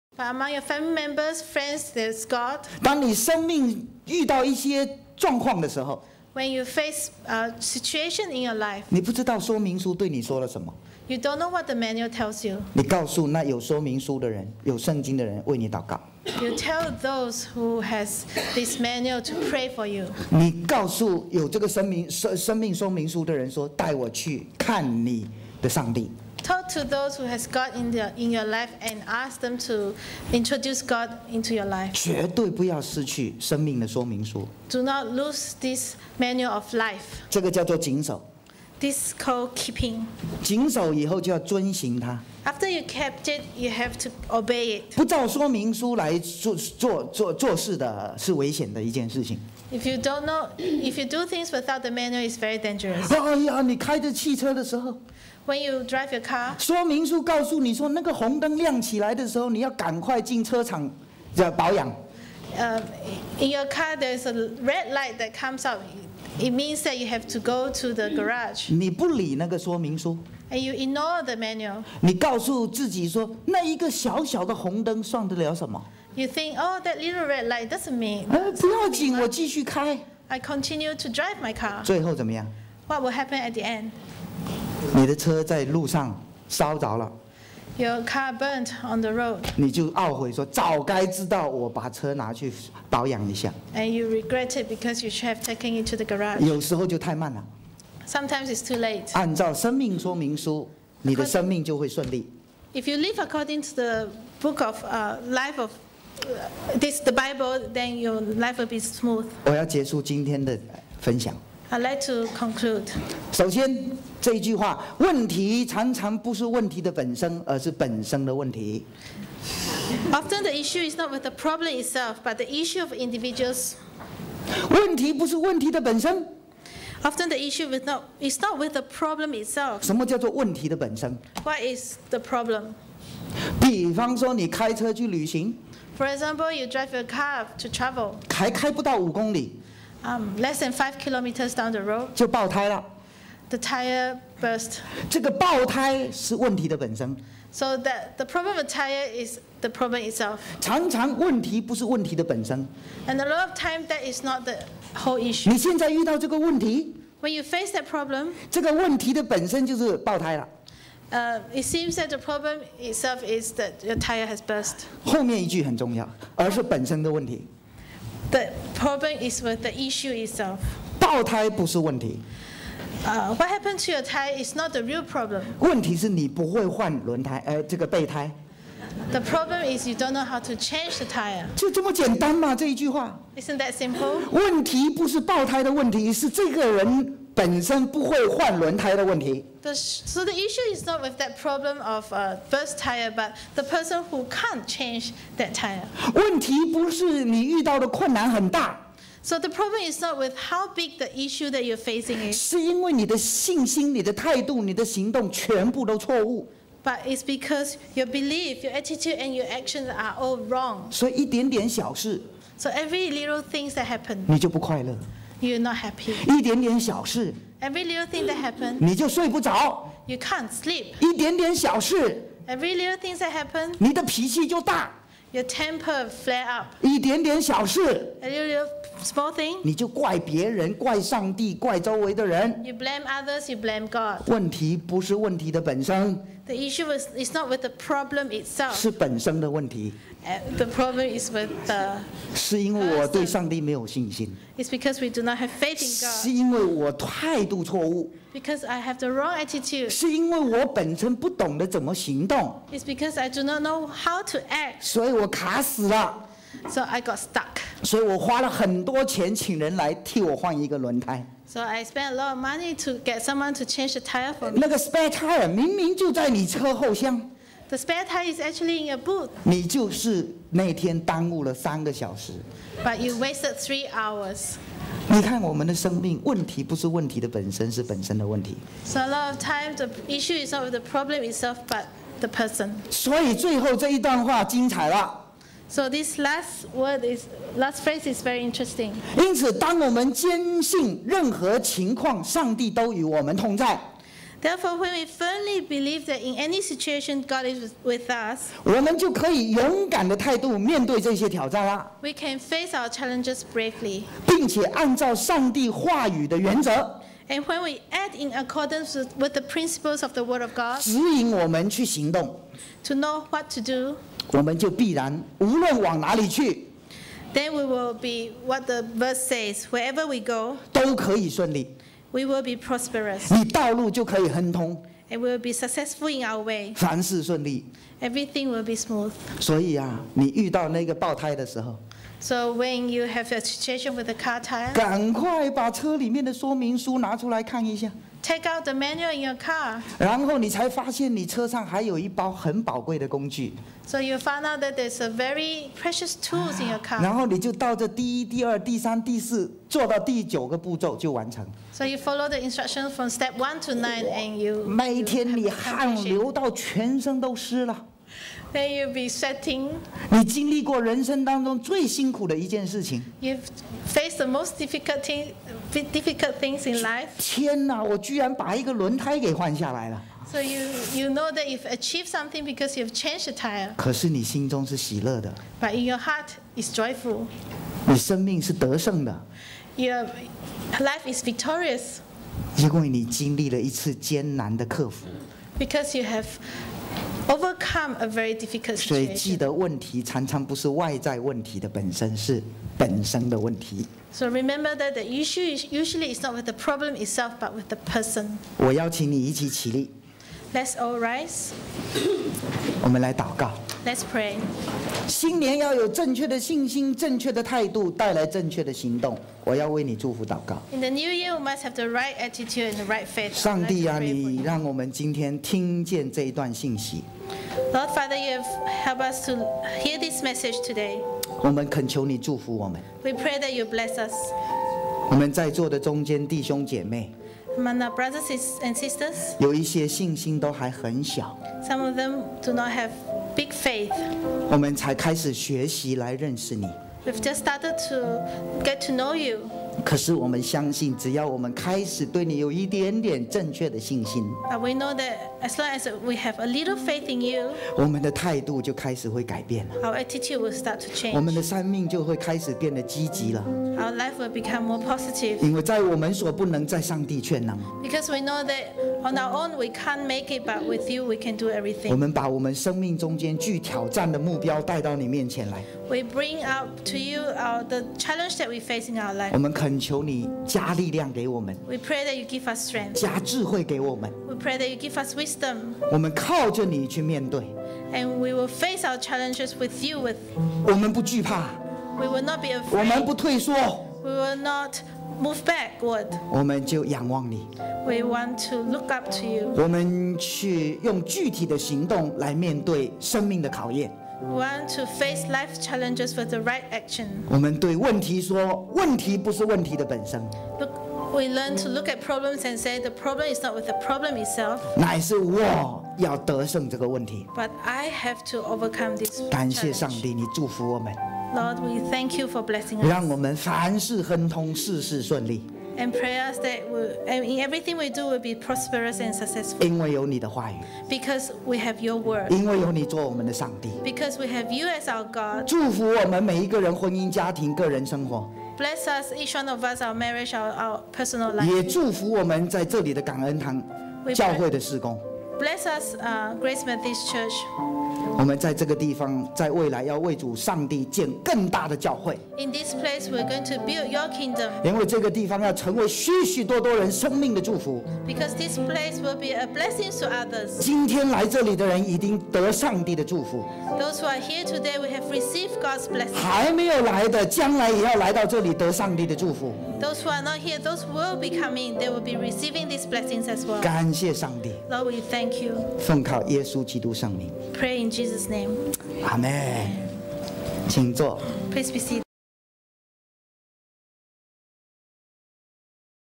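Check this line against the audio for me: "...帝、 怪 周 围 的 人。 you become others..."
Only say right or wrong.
wrong.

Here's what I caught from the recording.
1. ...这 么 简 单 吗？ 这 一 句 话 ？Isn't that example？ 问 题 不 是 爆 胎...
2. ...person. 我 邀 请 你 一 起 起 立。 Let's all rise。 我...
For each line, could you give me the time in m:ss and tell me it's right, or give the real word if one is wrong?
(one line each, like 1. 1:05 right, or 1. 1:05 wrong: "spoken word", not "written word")
1. 3:01 wrong: "simple", not "example"
2. 6:37 right.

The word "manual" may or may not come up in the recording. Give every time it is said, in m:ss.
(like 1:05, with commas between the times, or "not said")
0:11, 0:18, 0:36, 0:51, 1:11, 5:38.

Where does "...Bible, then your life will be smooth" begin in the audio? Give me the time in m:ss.
1:47.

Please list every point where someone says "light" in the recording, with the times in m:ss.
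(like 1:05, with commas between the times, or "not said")
1:04, 1:17.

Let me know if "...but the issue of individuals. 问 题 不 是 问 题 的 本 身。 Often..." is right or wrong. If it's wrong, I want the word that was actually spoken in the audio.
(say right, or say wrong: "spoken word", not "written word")
right.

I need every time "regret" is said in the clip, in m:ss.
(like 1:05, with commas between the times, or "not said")
1:34.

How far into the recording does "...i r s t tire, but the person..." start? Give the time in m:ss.
3:12.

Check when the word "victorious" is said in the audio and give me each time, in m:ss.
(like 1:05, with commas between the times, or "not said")
6:21.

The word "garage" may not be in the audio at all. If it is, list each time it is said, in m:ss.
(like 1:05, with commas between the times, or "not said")
1:08, 1:36.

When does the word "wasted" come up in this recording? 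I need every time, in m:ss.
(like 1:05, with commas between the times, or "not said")
4:33.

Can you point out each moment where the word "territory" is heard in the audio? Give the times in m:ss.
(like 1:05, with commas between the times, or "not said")
not said.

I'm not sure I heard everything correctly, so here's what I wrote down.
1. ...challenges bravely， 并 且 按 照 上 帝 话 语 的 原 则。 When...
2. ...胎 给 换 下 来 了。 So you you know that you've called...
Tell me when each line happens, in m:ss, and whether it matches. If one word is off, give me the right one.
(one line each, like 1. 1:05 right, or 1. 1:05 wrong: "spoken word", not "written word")
1. 5:02 wrong: "And", not "When"
2. 6:08 wrong: "achieved", not "called".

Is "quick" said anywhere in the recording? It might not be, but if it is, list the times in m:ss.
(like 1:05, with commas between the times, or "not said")
not said.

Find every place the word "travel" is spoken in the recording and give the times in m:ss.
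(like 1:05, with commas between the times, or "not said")
2:17.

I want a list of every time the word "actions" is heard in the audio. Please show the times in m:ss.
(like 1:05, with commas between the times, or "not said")
3:29, 8:16.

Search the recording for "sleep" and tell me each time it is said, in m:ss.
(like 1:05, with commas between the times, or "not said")
3:40.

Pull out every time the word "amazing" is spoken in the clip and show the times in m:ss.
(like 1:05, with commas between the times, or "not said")
not said.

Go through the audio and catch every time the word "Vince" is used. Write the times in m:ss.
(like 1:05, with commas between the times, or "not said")
not said.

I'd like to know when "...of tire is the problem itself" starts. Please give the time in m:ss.
2:28.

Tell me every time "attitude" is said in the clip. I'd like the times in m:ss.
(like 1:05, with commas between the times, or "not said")
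3:28, 4:09, 6:52, 7:30.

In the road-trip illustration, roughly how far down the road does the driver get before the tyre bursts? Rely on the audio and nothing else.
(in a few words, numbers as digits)
Less than five kilometers.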